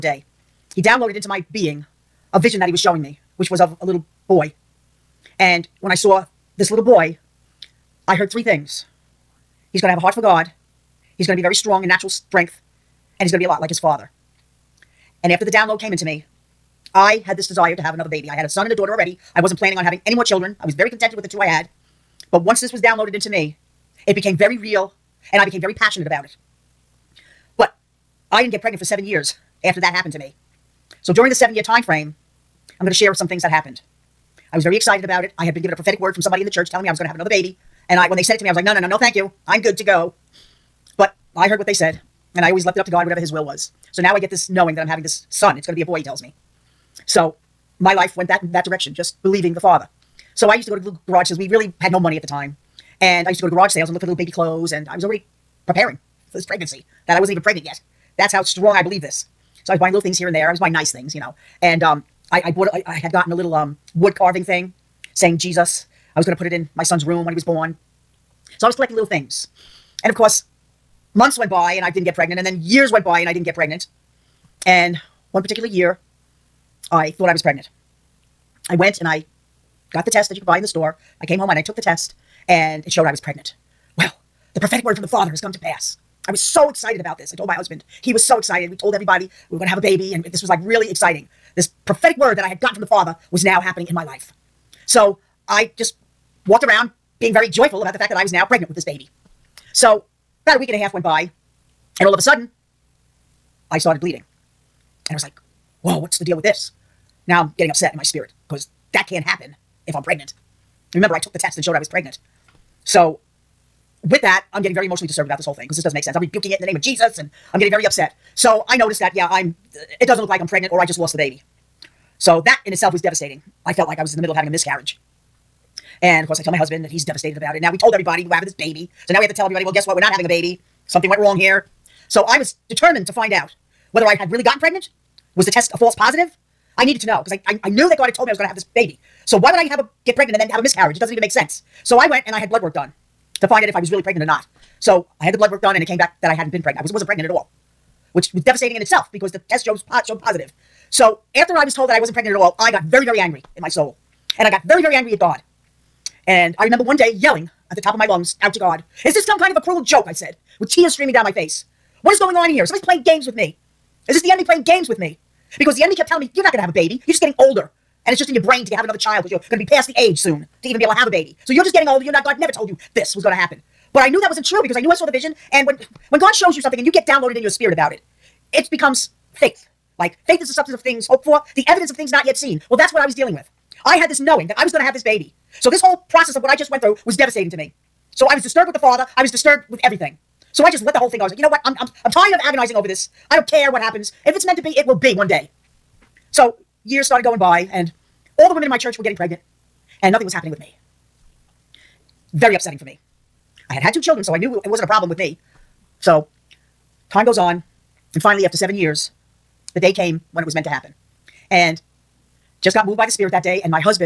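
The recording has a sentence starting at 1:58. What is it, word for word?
So I noticed that, yeah, I'm, uh, it doesn't look like I'm pregnant or I just lost the baby.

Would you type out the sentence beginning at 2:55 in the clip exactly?
And when when God shows you something and you get downloaded in your spirit about it, it becomes faith.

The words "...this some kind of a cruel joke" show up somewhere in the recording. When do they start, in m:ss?
2:39.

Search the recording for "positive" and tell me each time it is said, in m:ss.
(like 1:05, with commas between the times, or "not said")
2:15, 2:30.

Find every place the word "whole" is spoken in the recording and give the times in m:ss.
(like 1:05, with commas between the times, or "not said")
1:55, 3:05, 3:10.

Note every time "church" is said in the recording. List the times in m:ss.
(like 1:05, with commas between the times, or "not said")
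0:36, 3:18.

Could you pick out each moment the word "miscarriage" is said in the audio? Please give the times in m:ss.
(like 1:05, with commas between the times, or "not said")
2:04, 2:20.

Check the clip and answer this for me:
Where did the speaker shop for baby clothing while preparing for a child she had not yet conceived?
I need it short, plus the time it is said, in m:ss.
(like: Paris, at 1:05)
Garage sales, at 0:53.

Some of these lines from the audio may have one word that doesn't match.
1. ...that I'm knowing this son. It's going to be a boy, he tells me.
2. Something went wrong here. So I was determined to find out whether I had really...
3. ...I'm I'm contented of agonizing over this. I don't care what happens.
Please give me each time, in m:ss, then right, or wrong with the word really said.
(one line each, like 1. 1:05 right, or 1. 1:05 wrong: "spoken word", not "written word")
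1. 0:44 wrong: "having", not "knowing"
2. 2:10 right
3. 3:11 wrong: "tired", not "contented".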